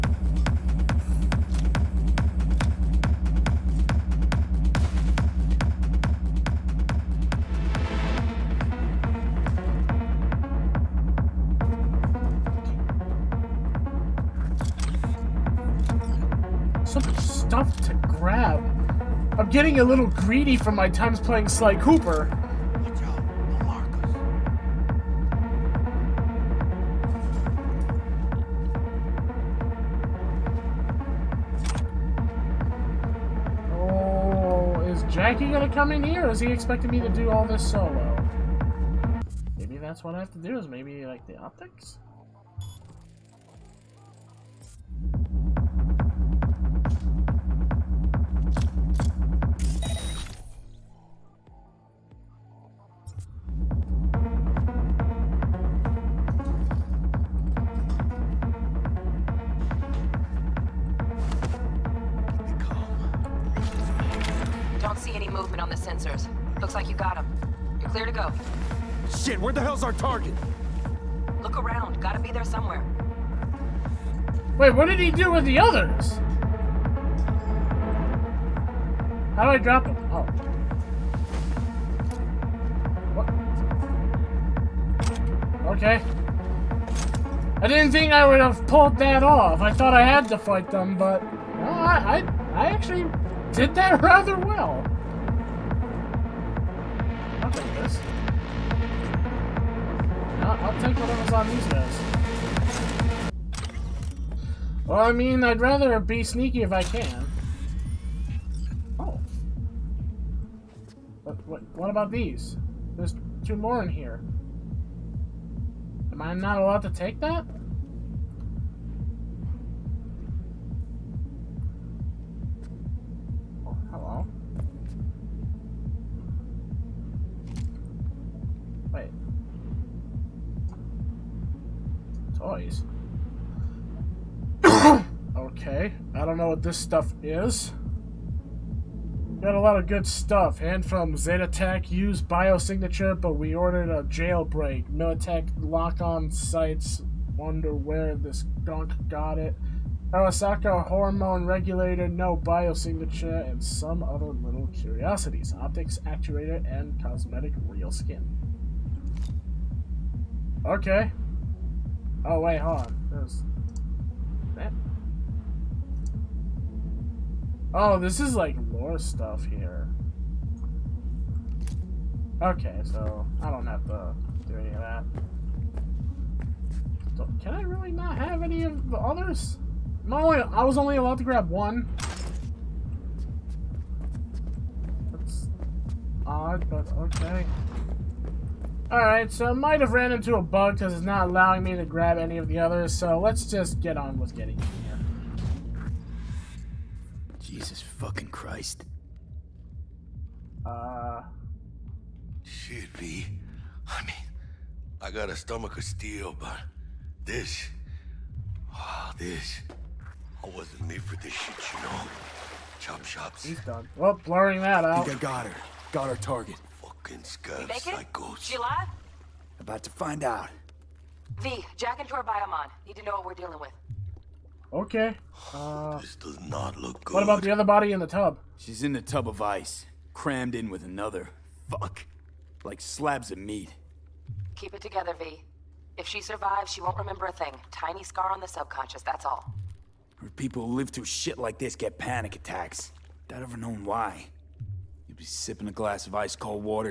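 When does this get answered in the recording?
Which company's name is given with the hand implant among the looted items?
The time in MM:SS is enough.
02:21.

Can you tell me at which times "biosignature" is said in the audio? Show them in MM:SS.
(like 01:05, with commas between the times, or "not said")
02:22, 02:32.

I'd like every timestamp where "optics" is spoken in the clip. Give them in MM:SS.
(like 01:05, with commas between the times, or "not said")
00:41, 02:35.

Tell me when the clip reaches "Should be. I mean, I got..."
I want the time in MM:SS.
03:22.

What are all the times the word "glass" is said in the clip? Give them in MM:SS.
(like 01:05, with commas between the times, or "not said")
04:05.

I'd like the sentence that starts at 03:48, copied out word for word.
She's in the tub of ice, crammed in with another.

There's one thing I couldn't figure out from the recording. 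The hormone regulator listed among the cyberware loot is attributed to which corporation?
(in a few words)
Arasaka.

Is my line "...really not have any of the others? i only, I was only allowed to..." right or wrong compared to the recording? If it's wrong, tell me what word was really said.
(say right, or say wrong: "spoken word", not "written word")
right.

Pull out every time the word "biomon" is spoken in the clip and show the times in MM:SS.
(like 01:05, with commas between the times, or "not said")
03:42.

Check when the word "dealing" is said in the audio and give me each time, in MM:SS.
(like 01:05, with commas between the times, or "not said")
03:43.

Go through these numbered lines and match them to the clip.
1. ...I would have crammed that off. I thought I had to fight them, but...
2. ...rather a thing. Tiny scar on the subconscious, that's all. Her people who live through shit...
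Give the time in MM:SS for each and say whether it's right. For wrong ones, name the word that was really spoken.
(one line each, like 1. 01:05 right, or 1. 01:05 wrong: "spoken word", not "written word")
1. 01:28 wrong: "pulled", not "crammed"
2. 03:56 wrong: "remember", not "rather".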